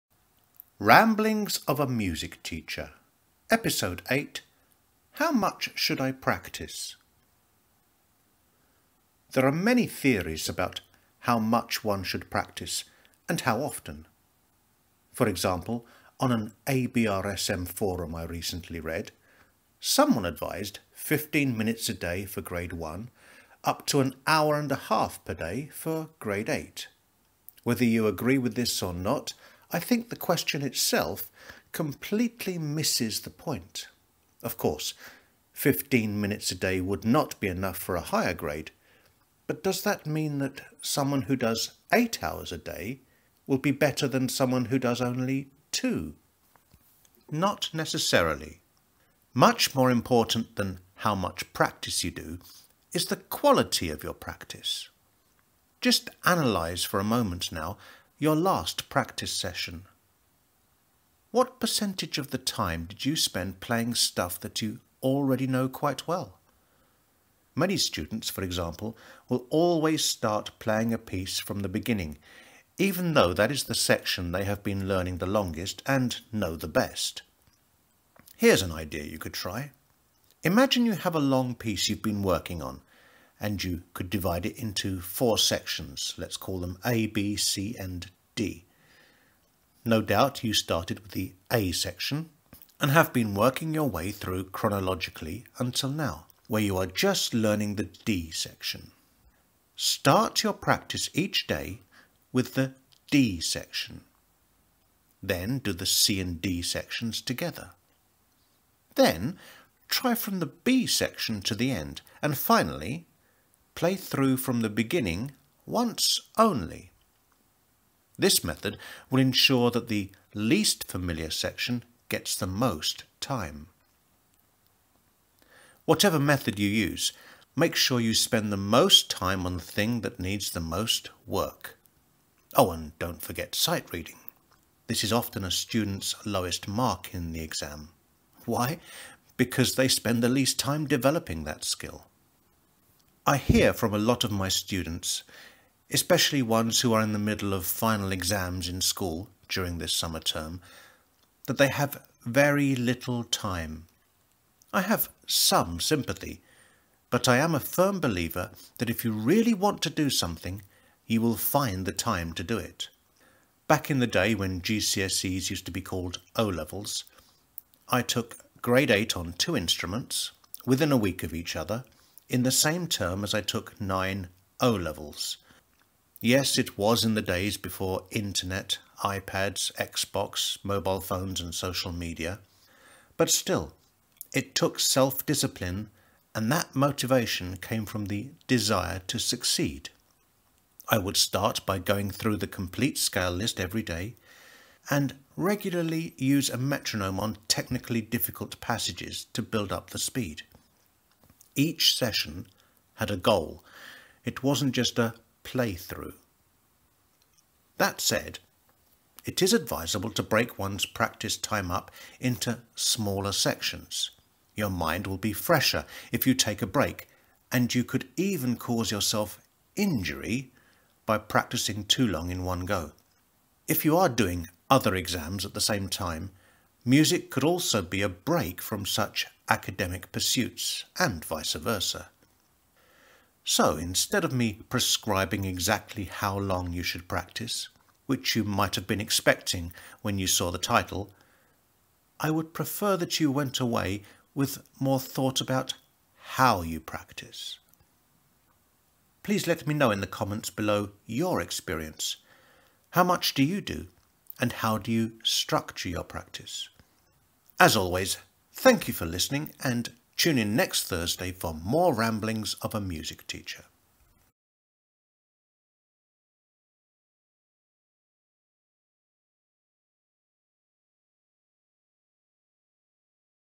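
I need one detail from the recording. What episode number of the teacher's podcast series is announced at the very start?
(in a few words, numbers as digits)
8.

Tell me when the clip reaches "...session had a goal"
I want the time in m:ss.
3:21.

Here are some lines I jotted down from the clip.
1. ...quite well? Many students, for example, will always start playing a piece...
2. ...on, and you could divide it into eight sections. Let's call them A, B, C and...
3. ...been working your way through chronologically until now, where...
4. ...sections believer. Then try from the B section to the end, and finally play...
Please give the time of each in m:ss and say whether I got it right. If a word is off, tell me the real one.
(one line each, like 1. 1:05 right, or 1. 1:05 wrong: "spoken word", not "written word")
1. 1:05 right
2. 1:22 wrong: "four", not "eight"
3. 1:33 right
4. 1:46 wrong: "together", not "believer".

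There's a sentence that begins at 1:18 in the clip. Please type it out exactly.
Here's an idea you could try.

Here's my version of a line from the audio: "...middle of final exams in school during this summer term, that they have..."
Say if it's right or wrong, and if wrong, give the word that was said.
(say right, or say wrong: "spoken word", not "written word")
right.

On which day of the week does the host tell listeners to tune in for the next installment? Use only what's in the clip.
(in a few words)
Thursday.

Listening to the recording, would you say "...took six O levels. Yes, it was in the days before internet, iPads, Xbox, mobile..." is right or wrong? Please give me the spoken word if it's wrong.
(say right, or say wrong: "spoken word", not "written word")
wrong: "nine", not "six".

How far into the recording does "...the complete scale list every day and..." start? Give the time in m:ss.
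3:12.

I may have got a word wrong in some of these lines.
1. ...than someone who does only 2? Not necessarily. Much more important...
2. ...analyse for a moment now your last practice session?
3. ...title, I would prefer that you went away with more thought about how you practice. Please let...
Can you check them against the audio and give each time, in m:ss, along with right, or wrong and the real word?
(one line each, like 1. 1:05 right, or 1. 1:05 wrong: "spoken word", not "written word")
1. 0:44 right
2. 0:56 right
3. 4:00 right.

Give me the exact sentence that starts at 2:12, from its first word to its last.
Oh, and don't forget sight reading.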